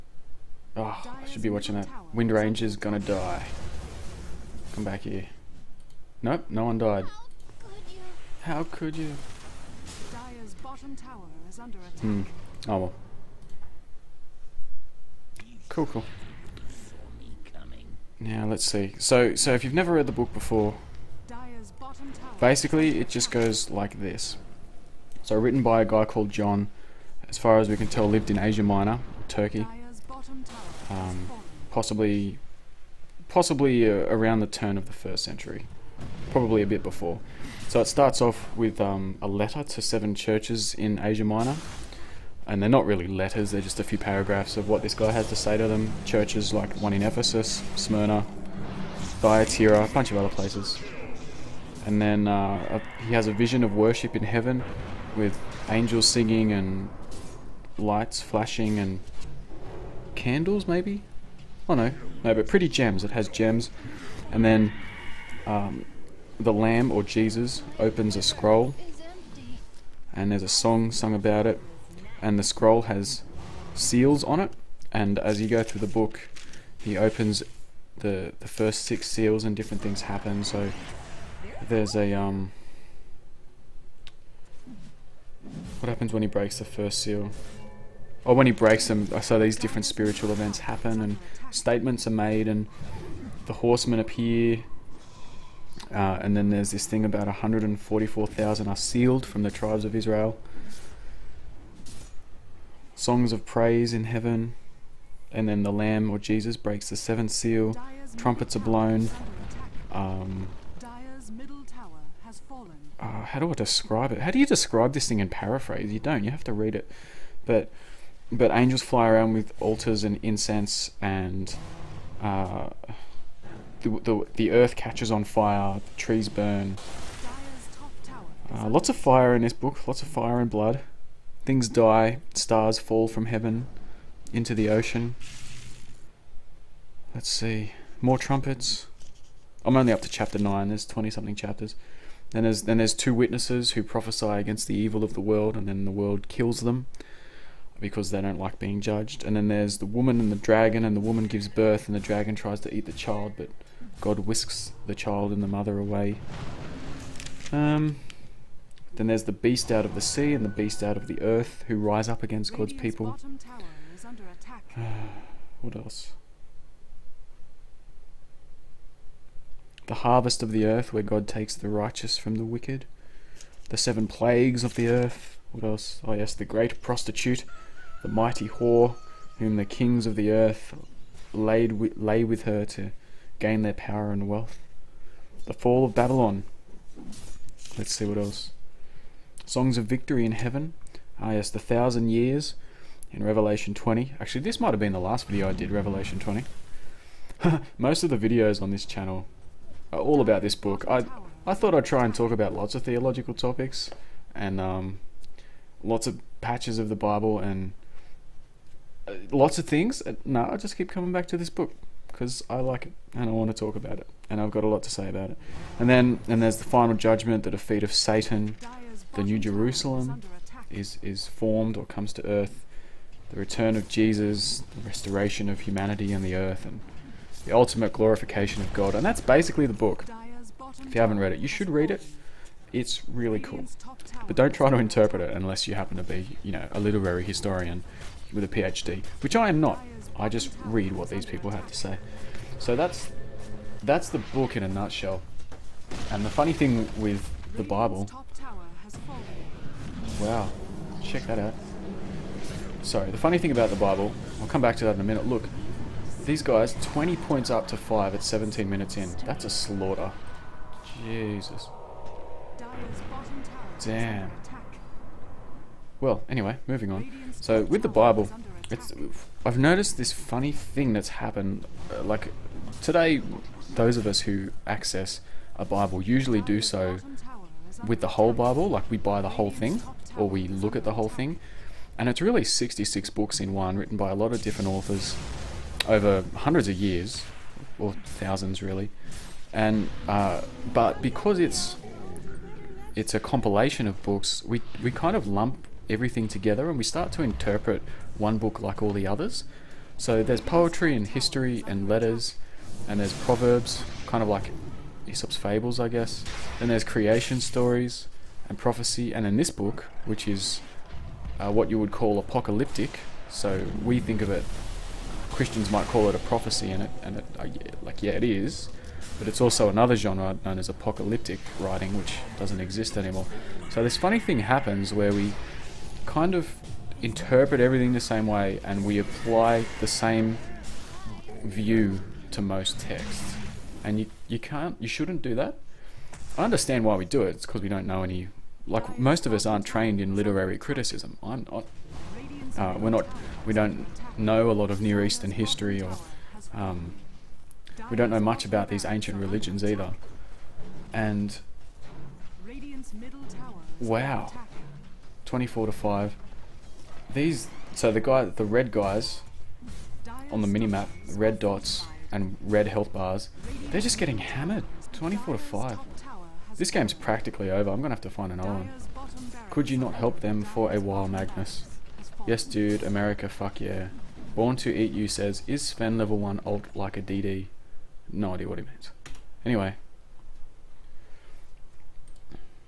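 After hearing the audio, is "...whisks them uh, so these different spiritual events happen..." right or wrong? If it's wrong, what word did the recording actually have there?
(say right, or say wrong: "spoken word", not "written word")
wrong: "breaks", not "whisks".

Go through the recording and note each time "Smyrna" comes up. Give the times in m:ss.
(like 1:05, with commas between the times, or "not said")
0:47.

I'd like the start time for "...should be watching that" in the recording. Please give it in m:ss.
0:01.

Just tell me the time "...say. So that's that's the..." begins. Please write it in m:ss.
4:01.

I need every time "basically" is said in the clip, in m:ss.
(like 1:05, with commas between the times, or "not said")
0:22, 3:49.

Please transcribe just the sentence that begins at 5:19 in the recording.
But it's also another genre known as apocalyptic writing, which doesn't exist anymore.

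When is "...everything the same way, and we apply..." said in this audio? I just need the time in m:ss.
5:27.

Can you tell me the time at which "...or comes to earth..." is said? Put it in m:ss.
3:41.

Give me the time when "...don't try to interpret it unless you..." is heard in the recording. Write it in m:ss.
3:54.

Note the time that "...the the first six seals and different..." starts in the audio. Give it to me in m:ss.
1:17.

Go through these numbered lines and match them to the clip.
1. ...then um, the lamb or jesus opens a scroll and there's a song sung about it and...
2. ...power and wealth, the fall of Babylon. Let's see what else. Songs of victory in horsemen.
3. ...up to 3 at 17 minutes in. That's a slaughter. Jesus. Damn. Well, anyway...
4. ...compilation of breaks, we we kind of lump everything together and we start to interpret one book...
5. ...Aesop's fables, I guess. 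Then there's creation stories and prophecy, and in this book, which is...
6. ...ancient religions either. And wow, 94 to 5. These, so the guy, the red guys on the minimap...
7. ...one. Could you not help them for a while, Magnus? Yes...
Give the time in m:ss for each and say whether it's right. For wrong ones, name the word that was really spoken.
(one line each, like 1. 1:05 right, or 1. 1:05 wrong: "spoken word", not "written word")
1. 1:04 right
2. 3:03 wrong: "heaven", not "horsemen"
3. 4:17 wrong: "5", not "3"
4. 4:53 wrong: "books", not "breaks"
5. 5:05 right
6. 5:48 wrong: "24", not "94"
7. 6:08 right.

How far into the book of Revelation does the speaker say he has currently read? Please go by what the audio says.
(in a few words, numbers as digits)
Chapter 9.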